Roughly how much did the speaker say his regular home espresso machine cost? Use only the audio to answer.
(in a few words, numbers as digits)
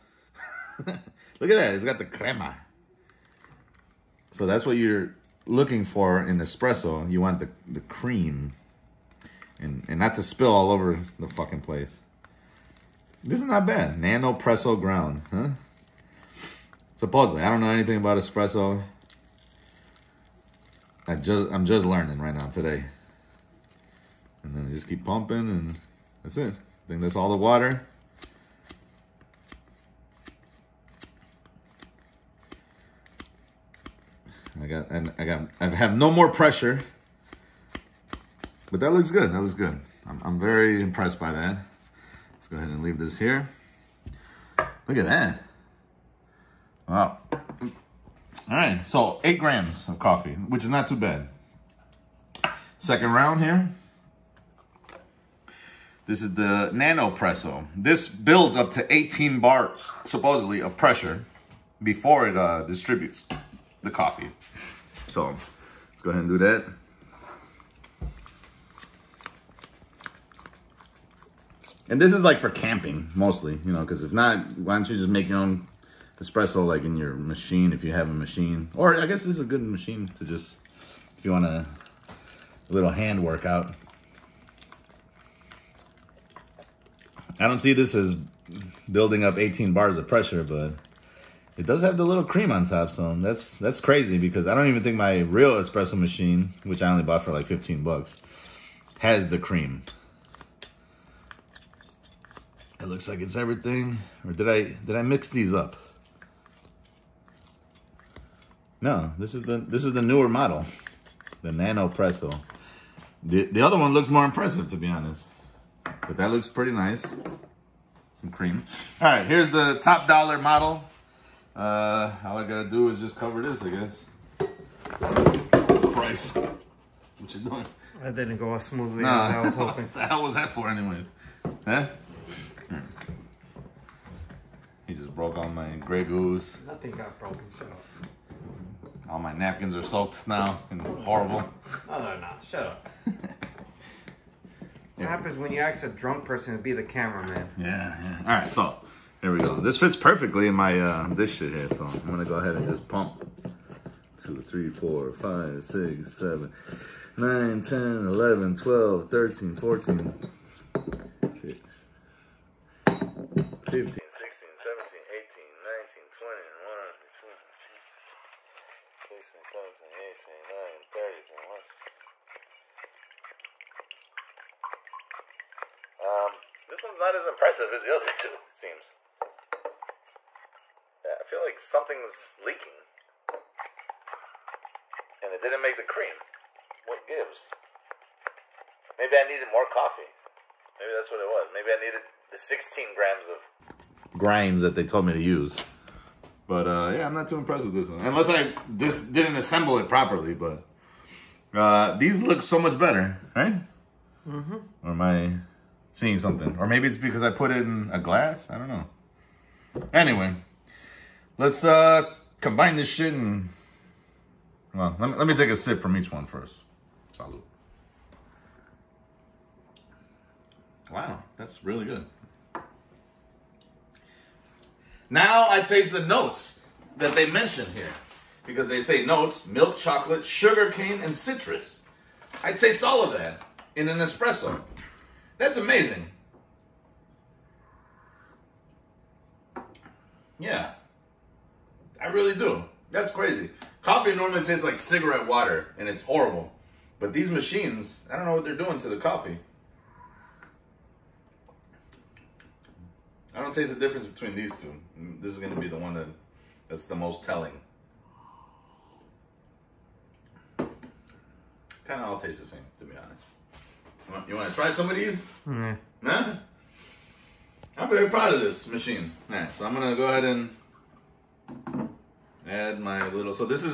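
15 bucks.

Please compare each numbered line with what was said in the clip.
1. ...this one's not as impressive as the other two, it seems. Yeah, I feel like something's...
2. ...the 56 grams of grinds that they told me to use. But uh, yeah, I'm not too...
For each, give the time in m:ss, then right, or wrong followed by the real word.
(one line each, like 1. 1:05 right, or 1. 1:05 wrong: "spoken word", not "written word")
1. 2:56 right
2. 3:12 wrong: "16", not "56".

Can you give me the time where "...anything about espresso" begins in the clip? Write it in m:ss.
0:17.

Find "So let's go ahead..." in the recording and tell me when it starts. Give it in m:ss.
1:05.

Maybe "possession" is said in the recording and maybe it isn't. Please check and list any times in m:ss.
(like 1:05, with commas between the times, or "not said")
not said.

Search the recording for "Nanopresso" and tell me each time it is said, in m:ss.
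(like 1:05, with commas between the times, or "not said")
0:14, 0:56, 1:51.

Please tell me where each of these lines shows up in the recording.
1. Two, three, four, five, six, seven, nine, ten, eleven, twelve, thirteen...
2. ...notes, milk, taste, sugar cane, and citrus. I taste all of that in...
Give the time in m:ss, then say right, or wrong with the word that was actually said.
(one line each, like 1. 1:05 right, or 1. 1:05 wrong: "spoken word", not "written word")
1. 2:34 right
2. 3:49 wrong: "chocolate", not "taste".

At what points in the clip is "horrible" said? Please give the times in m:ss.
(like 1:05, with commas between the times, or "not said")
2:20, 4:06.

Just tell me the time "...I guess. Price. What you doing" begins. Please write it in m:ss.
2:03.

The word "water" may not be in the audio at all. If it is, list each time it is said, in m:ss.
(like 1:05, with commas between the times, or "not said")
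0:27, 4:05.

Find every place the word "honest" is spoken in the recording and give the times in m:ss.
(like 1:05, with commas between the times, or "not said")
1:54, 4:22.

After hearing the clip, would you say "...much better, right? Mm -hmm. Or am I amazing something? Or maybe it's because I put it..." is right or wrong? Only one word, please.
wrong.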